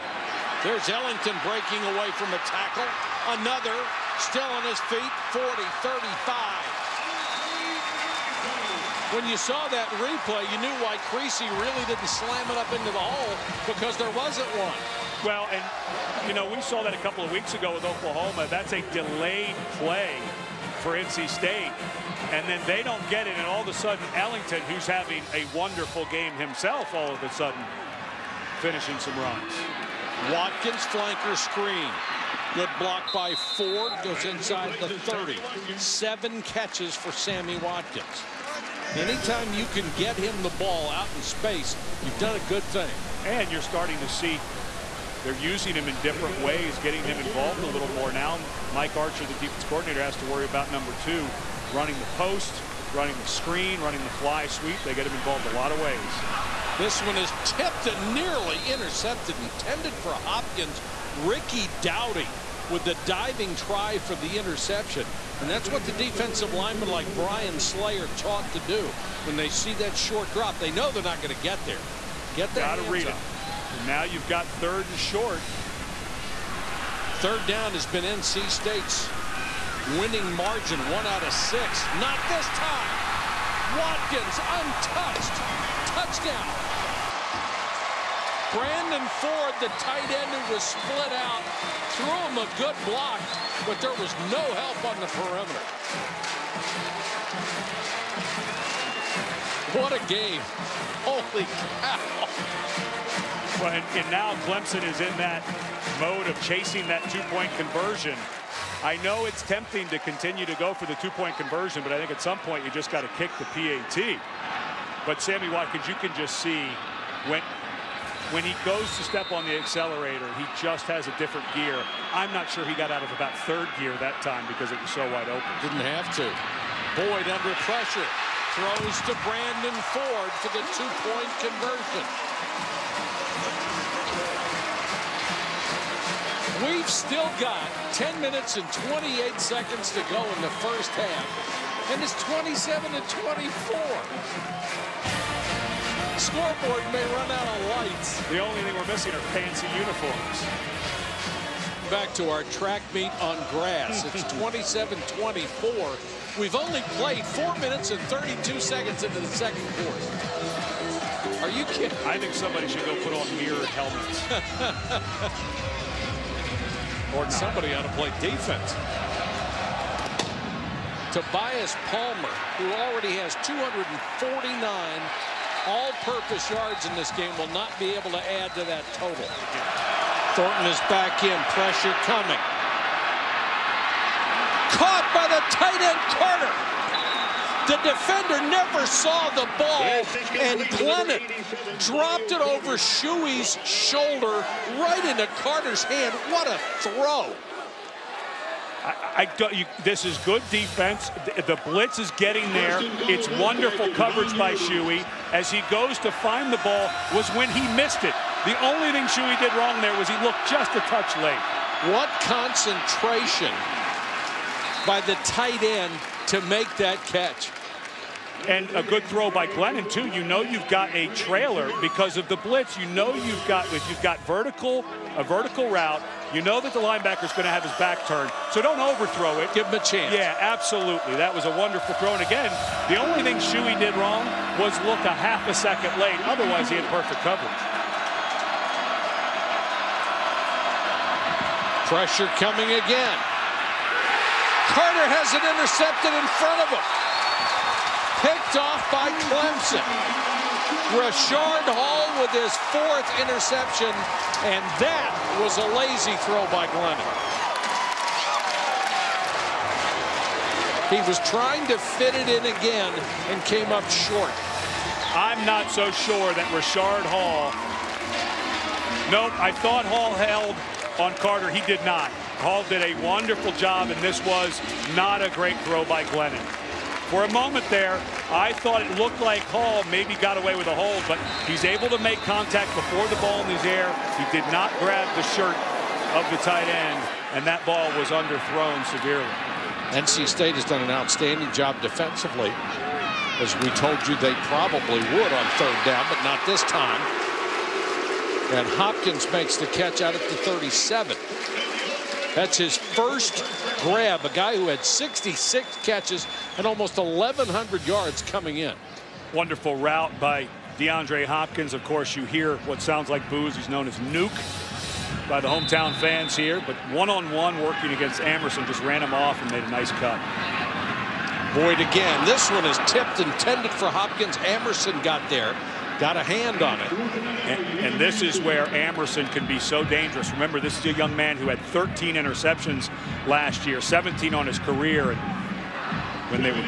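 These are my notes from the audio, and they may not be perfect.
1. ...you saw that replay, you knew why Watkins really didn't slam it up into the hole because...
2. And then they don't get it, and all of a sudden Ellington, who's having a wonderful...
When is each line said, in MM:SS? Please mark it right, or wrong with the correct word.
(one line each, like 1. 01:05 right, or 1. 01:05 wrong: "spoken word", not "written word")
1. 00:09 wrong: "Creecy", not "Watkins"
2. 00:22 right.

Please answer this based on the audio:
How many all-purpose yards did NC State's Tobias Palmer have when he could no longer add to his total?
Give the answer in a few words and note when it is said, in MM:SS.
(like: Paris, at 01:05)
249, at 02:53.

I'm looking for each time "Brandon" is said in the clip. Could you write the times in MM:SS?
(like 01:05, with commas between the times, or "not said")
01:28, 02:09.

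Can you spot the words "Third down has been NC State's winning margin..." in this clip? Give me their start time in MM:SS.
01:17.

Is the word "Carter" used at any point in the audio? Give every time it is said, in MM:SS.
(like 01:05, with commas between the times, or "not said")
03:06, 03:15, 04:04, 04:31.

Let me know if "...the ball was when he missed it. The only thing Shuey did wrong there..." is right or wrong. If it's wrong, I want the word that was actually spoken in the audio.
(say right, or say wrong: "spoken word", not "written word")
right.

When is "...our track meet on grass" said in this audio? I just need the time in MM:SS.
02:32.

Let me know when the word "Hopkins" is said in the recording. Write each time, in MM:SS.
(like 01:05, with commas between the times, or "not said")
01:00, 04:58, 05:11, 05:23.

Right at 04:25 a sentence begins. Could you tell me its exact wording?
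I'm not so sure that Rashard Hall.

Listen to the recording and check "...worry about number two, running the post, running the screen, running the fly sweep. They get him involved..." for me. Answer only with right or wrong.
right.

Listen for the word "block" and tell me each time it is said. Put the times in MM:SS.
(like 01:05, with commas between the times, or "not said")
00:32, 01:32.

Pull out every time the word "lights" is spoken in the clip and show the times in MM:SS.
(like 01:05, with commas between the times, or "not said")
02:27.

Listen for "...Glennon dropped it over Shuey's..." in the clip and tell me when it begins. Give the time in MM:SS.
03:10.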